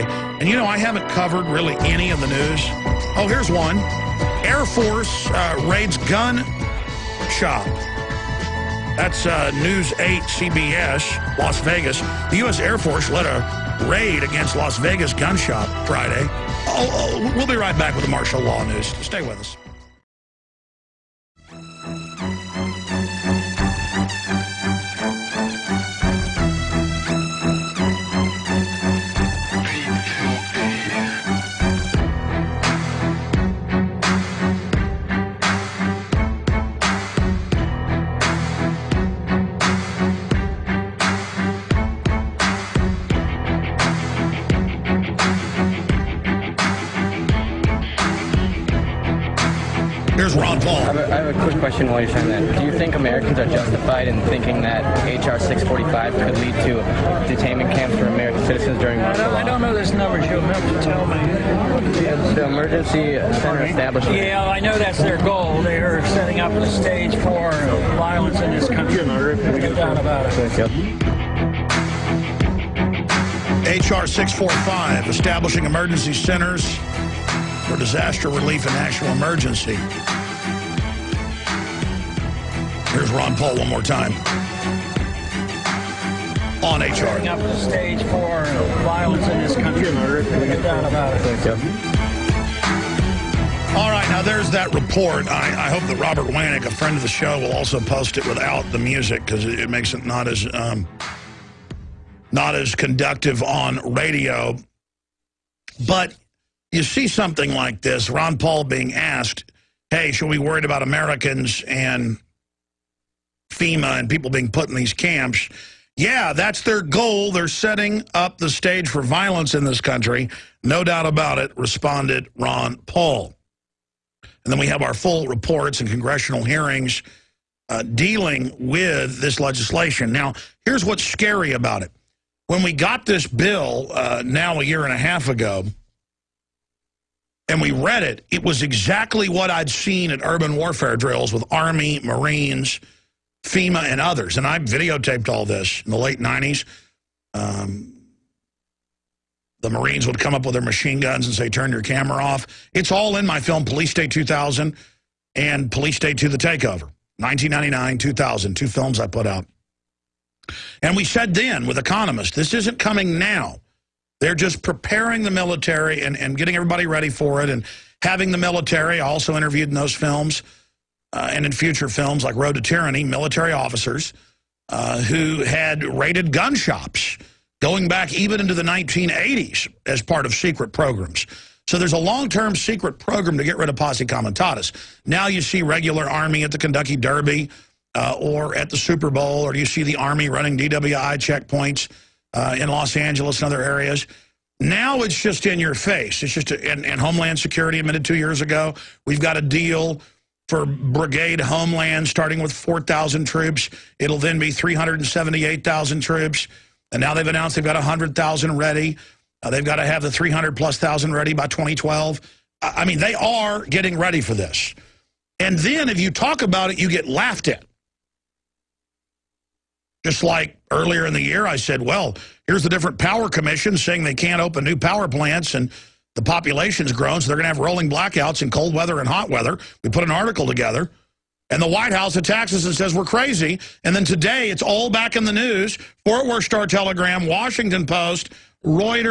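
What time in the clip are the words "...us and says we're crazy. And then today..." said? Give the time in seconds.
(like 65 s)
232 s.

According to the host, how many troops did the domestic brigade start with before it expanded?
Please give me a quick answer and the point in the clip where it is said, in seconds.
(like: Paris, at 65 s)
4,000, at 202 s.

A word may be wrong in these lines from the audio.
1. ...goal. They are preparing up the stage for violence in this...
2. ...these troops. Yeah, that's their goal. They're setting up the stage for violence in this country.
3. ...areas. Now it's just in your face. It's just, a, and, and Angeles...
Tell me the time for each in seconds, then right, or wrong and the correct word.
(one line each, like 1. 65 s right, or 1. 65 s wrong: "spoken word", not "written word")
1. 65 s wrong: "setting", not "preparing"
2. 114 s wrong: "camps", not "troops"
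3. 193 s wrong: "Homeland", not "Angeles".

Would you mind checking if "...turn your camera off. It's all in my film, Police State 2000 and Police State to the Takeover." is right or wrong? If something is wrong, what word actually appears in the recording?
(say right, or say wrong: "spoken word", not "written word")
right.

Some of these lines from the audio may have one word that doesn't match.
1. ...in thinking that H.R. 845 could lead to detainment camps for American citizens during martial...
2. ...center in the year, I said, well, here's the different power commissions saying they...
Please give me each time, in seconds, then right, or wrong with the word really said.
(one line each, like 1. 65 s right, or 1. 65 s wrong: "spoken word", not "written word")
1. 54 s wrong: "645", not "845"
2. 220 s wrong: "earlier", not "center".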